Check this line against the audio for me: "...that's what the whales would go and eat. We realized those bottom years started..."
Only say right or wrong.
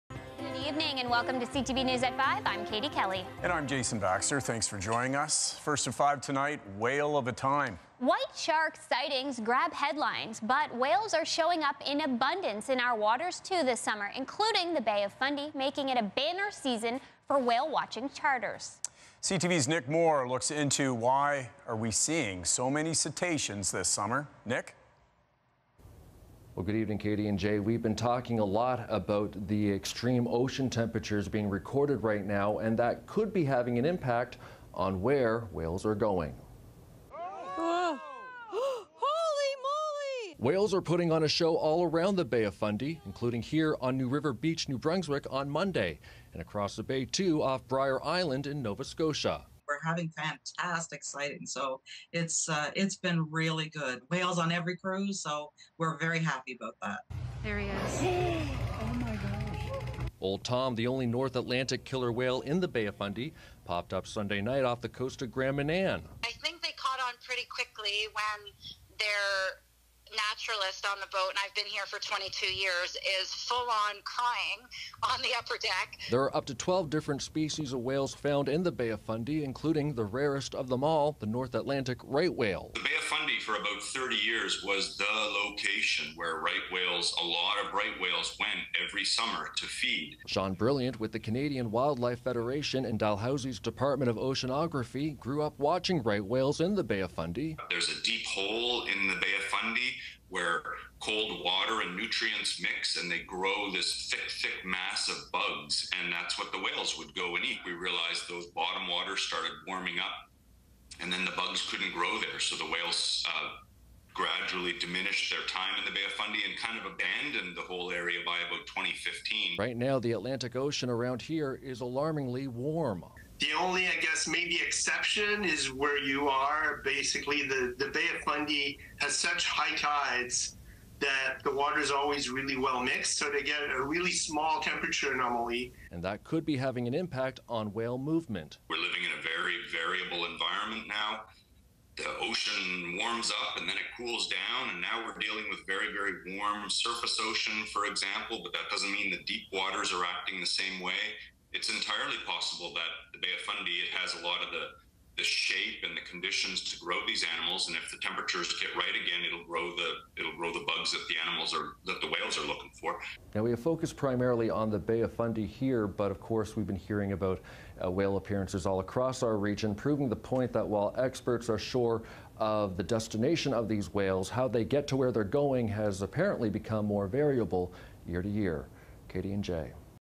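wrong.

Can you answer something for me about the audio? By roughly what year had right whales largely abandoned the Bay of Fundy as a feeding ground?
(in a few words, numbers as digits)
2015.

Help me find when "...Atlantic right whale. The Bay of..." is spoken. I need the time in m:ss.
1:21.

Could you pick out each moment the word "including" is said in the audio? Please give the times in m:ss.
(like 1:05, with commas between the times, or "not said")
0:14, 0:43, 1:19.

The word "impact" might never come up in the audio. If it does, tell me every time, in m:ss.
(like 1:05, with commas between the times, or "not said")
0:33, 2:16.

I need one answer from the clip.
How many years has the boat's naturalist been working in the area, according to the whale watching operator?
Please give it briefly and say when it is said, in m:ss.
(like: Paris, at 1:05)
22, at 1:11.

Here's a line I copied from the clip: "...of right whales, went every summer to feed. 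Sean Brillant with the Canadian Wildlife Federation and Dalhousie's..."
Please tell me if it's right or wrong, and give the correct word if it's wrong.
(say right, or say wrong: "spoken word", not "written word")
right.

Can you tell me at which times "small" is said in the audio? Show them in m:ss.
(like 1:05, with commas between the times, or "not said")
2:14.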